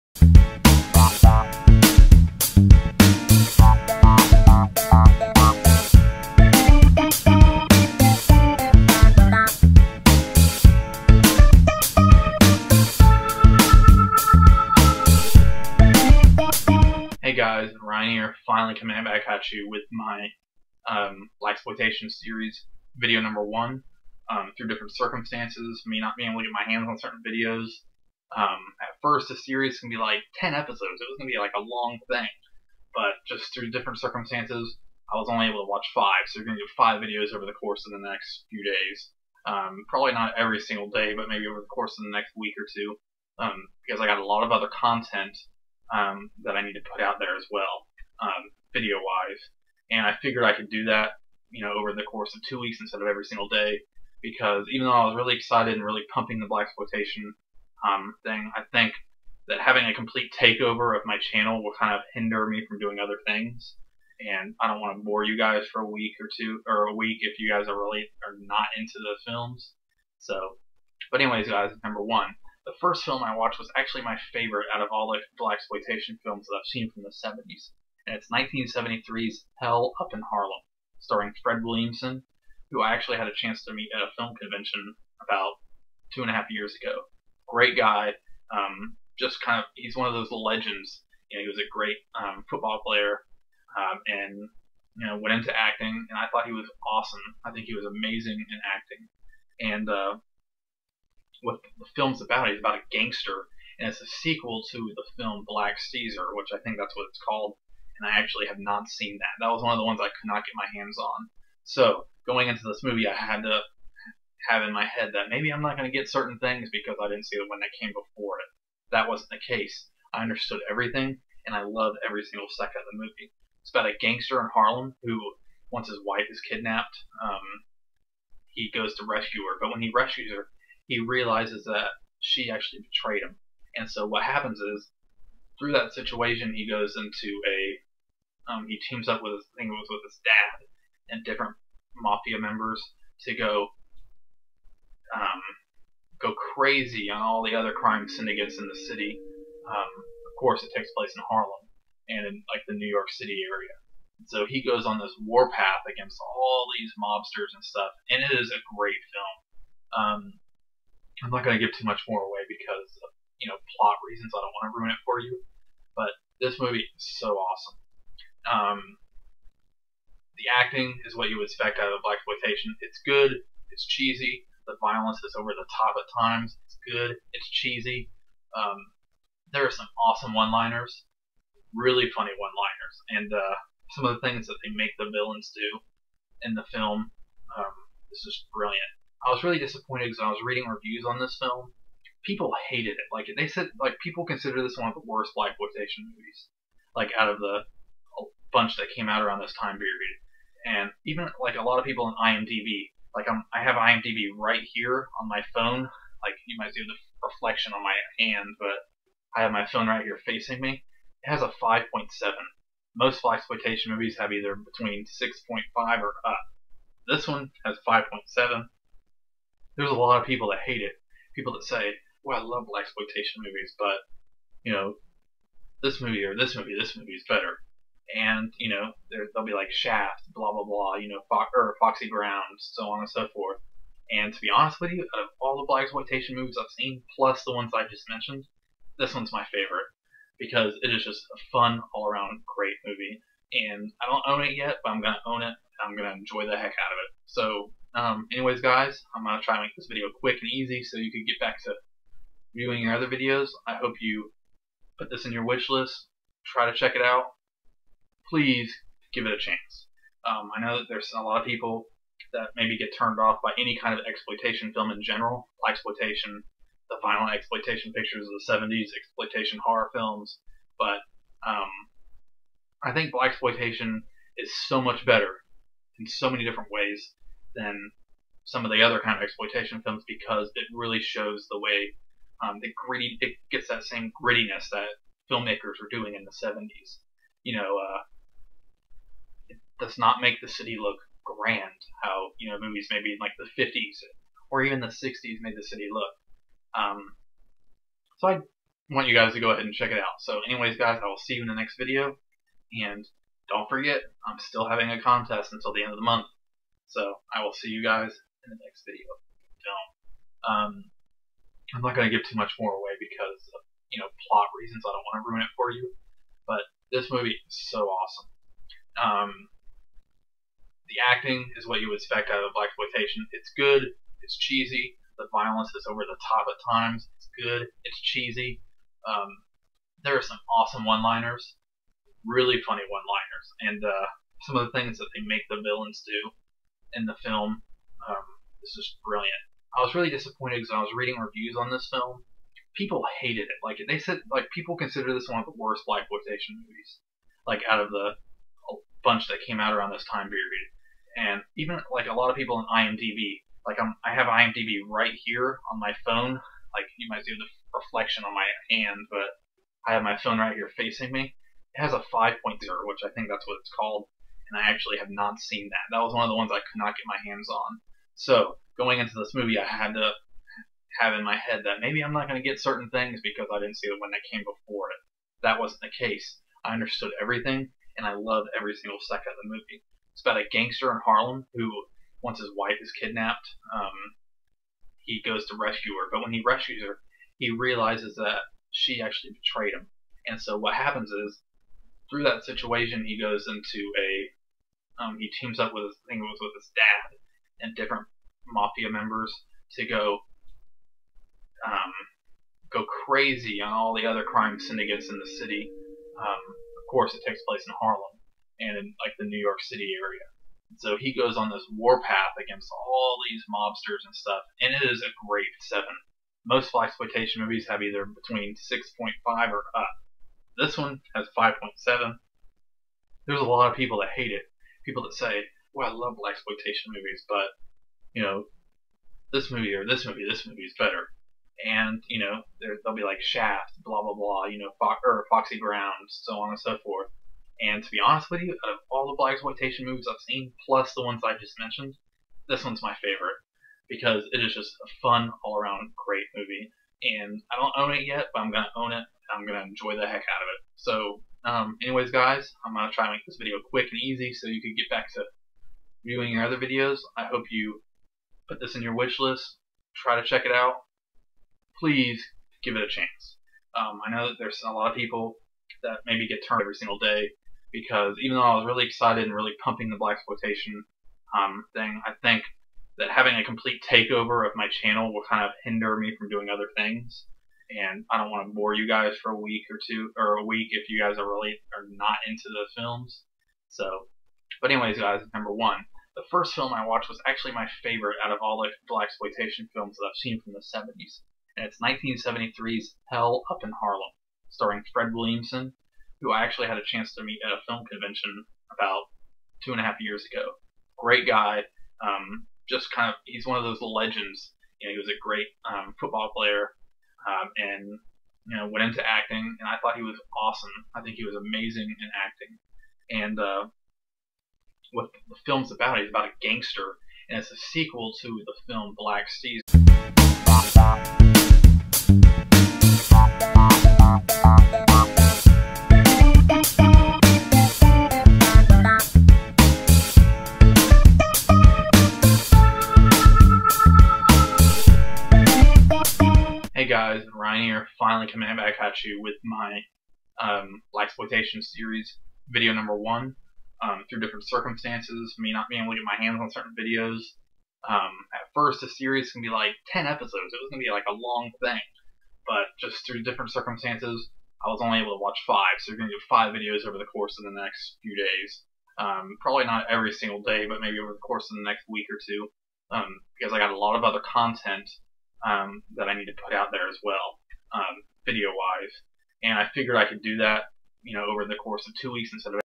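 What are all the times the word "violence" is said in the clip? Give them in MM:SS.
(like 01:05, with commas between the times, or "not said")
02:54, 05:25.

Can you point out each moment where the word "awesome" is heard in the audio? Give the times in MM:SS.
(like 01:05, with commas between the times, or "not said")
01:36, 02:47, 03:00, 05:17, 05:30, 08:30.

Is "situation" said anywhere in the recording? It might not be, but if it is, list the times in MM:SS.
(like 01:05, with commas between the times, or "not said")
02:15, 06:32.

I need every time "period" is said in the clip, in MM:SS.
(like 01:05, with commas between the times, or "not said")
03:19, 05:50.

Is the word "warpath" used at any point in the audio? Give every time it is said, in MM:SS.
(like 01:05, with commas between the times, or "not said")
02:35, 06:51.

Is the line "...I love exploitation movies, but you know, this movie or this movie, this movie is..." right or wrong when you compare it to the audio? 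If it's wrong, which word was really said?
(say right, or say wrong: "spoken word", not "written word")
wrong: "blaxploitation", not "exploitation".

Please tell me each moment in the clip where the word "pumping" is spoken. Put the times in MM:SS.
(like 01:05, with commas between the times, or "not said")
00:56, 07:49.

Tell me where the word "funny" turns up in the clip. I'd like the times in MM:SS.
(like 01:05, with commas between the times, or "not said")
03:02, 05:32.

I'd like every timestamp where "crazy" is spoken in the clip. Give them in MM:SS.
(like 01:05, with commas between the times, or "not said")
02:26, 06:43.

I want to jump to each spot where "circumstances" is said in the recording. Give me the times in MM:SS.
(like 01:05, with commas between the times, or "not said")
00:24, 00:33, 09:04, 09:13.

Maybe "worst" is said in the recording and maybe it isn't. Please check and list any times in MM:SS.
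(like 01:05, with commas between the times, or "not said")
03:15, 05:45.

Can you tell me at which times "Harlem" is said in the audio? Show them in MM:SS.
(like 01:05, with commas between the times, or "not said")
01:20, 02:04, 02:31, 06:21, 06:47, 08:13.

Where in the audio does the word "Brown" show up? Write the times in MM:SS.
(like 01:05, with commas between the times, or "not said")
03:52, 07:15.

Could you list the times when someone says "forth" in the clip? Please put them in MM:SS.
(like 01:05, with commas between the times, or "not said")
03:53, 07:16.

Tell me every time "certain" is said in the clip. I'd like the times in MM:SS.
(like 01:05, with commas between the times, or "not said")
00:26, 01:56, 06:12, 09:06.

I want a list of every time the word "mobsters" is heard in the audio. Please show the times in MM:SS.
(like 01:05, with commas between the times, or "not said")
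02:36, 06:53.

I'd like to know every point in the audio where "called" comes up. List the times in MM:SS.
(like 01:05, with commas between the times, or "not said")
01:47, 06:03.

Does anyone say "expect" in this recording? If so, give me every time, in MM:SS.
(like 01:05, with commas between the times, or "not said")
02:51, 05:22.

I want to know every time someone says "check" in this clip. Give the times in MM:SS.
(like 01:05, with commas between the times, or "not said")
04:16, 04:59, 07:40.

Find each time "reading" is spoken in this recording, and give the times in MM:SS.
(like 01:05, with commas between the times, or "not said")
03:10, 05:40.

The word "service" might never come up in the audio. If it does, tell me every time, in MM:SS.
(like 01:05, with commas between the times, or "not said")
not said.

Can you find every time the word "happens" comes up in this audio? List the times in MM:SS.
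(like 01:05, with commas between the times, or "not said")
02:14, 06:30.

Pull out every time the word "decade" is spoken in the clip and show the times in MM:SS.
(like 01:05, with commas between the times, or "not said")
not said.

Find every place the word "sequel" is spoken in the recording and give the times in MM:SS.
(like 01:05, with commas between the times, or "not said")
01:44, 08:37.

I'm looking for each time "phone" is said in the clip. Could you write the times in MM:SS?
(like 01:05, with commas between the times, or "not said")
03:25, 03:29, 05:56, 06:00.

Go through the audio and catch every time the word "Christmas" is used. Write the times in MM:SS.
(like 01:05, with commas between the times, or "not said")
not said.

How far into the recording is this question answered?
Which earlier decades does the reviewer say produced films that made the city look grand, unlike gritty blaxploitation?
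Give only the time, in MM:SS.
04:53.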